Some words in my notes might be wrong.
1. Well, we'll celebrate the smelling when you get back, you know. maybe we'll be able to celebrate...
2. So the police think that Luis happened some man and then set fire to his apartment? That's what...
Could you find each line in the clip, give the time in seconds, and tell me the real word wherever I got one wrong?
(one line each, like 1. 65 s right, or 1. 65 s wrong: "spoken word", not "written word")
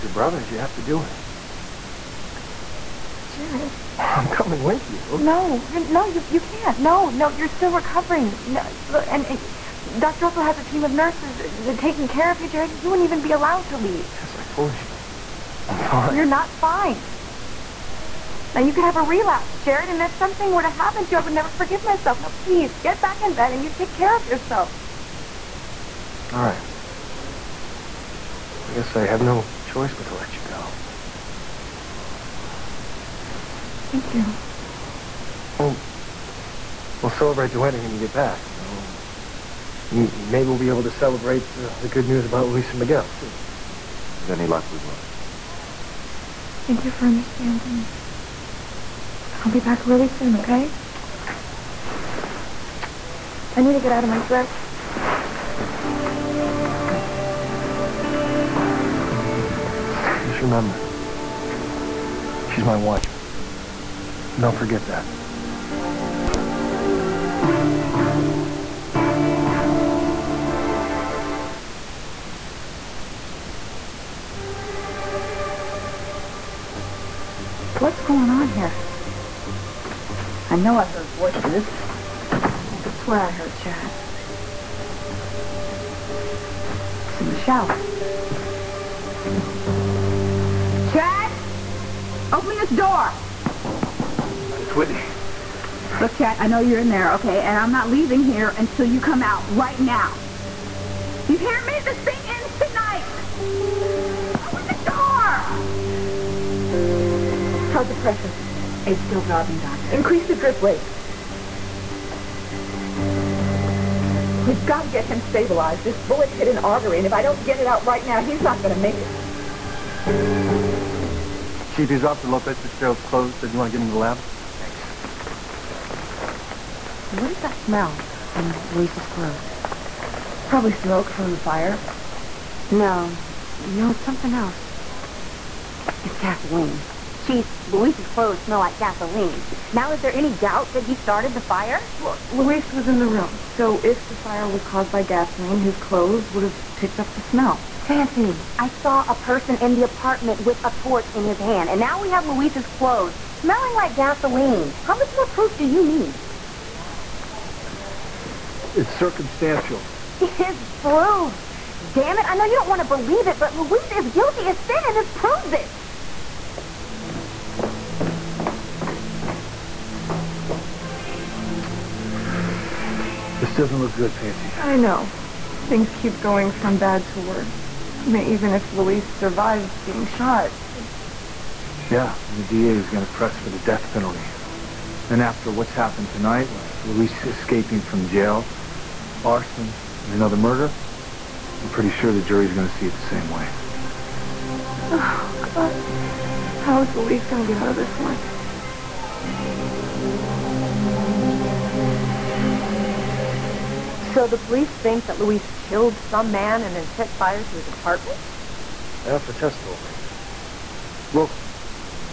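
1. 35 s wrong: "wedding", not "smelling"
2. 204 s wrong: "killed", not "happened".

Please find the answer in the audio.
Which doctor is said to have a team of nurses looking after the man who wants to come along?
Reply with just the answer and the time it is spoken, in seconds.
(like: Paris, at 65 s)
Dr. Russell, at 9 s.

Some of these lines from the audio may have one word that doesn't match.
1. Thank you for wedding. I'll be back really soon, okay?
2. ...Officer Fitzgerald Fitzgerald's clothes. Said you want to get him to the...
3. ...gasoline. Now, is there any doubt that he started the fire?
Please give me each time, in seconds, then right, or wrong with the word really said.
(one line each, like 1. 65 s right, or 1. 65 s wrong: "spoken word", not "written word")
1. 46 s wrong: "understanding", not "wedding"
2. 122 s wrong: "Lopez", not "Fitzgerald"
3. 138 s right.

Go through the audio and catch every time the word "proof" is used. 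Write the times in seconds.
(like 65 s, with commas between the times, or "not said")
155 s, 160 s.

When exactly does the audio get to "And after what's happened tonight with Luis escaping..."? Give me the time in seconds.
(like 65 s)
185 s.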